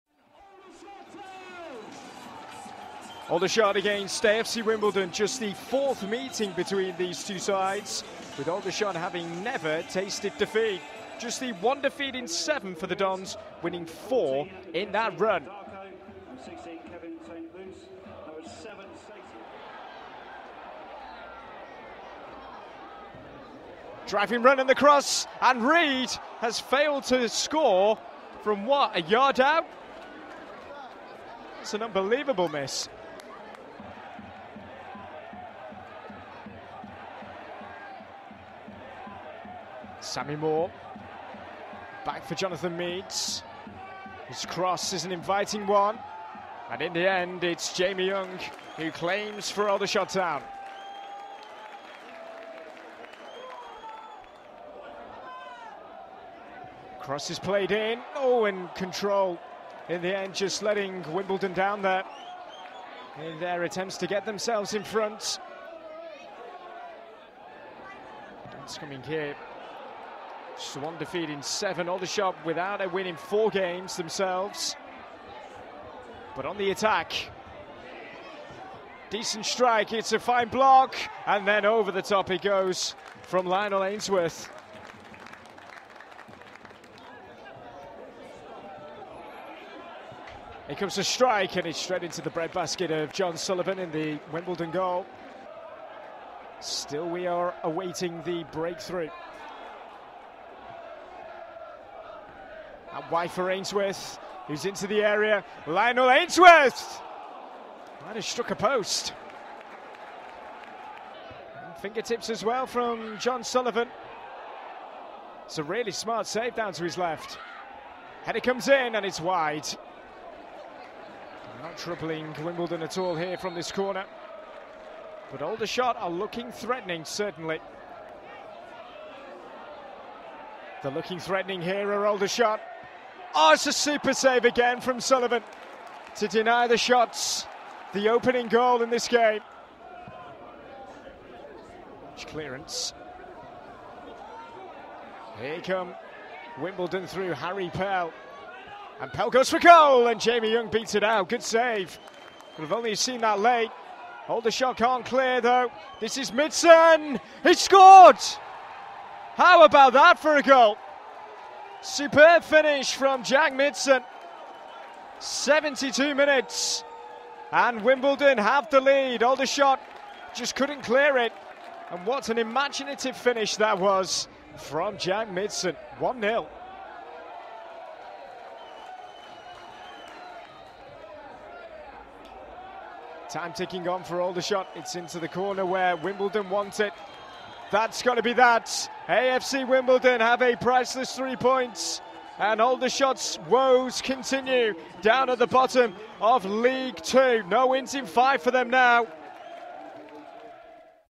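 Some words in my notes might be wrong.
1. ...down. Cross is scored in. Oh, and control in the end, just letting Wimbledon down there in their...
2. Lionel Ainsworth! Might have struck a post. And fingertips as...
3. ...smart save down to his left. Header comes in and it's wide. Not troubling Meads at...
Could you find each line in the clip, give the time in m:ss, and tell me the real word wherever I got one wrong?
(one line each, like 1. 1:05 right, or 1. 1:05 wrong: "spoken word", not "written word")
1. 0:50 wrong: "played", not "scored"
2. 1:45 right
3. 1:55 wrong: "Wimbledon", not "Meads".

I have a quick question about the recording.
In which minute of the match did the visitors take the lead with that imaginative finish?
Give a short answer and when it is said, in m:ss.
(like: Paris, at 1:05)
72, at 2:45.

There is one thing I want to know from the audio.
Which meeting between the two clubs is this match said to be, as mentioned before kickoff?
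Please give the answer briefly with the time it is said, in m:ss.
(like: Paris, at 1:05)
fourth, at 0:05.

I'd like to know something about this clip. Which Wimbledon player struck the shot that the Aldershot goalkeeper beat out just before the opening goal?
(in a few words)
Harry Pell.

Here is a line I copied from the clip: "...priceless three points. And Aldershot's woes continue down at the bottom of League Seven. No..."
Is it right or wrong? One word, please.
wrong.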